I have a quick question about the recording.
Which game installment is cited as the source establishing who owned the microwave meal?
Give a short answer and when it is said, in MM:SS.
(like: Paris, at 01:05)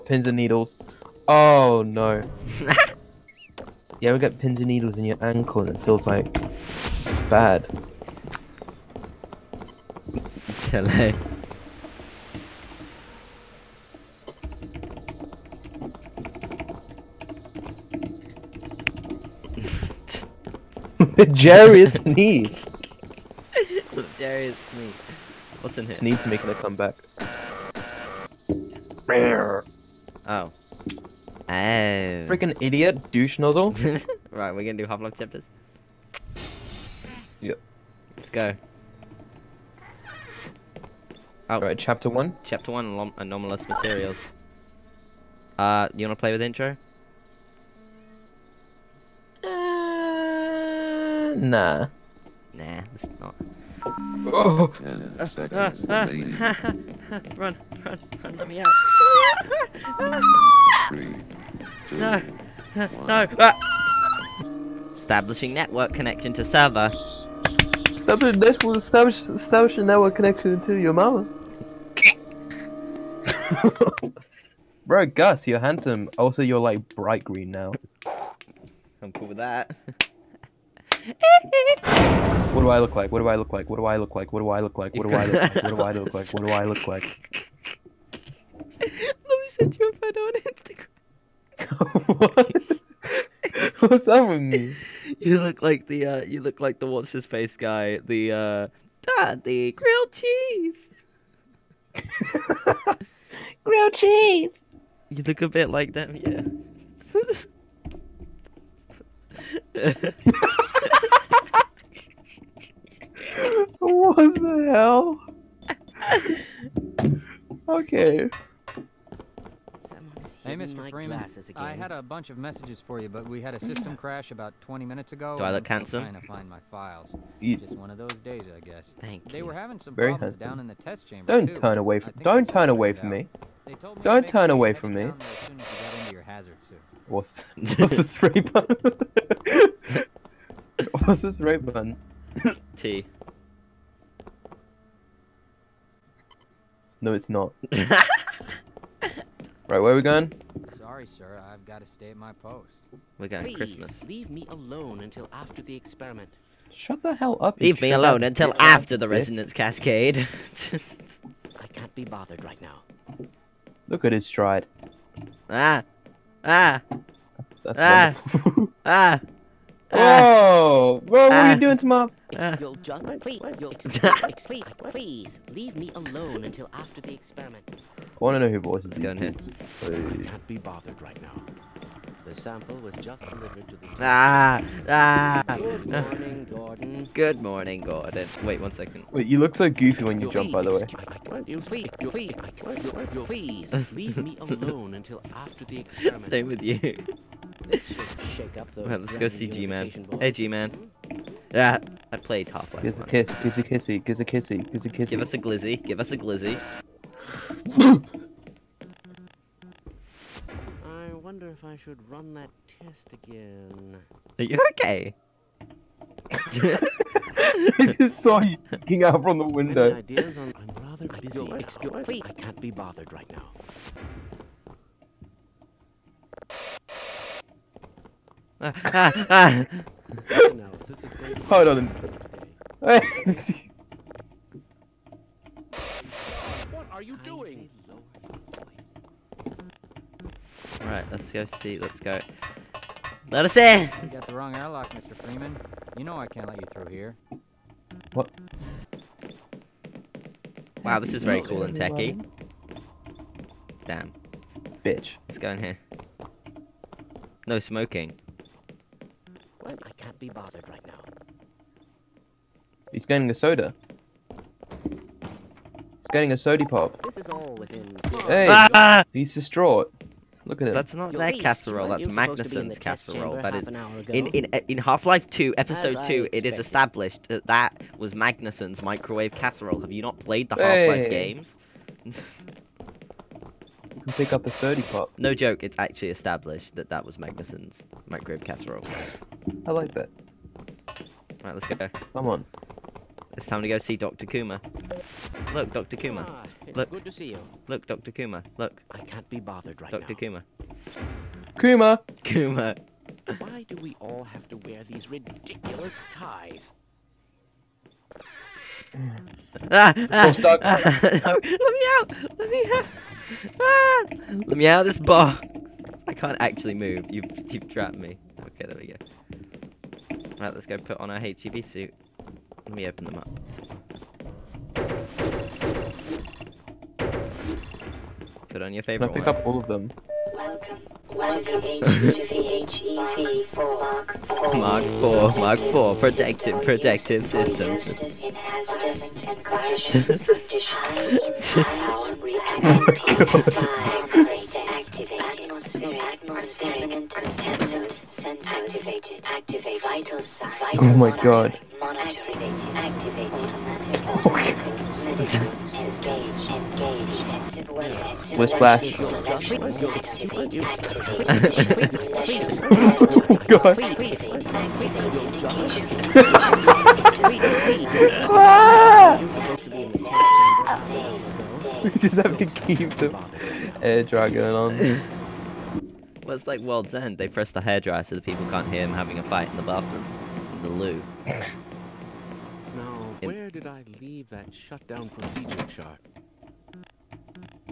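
Half Life Two, Episode Two, at 04:34.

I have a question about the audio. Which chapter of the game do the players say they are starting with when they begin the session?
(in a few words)
Anomalous Materials.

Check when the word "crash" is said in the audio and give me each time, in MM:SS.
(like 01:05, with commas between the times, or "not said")
02:03.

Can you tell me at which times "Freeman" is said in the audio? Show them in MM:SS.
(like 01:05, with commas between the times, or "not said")
02:00, 04:05.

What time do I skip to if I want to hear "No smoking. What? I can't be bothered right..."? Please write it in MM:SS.
04:17.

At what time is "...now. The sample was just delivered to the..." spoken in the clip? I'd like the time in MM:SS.
03:01.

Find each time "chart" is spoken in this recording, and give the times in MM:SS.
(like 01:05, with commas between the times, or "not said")
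06:25.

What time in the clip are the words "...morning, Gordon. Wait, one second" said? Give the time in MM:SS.
03:07.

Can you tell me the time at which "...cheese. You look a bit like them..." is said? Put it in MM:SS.
01:43.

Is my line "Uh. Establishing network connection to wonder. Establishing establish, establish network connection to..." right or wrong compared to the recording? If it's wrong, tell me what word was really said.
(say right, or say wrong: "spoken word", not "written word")
wrong: "server", not "wonder".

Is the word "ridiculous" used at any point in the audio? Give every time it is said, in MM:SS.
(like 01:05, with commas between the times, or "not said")
05:05.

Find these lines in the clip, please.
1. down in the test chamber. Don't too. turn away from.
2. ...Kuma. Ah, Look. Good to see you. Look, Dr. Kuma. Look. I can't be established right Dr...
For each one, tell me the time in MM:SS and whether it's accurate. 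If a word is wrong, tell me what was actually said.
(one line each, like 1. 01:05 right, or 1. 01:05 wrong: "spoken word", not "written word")
1. 02:10 right
2. 04:55 wrong: "bothered", not "established".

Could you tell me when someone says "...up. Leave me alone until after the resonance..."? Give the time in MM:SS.
02:37.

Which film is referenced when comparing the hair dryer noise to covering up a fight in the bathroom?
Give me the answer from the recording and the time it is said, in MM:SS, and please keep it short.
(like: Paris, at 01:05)
World's End, at 06:16.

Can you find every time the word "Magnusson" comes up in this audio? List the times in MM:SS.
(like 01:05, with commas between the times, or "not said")
04:32, 04:38, 04:47.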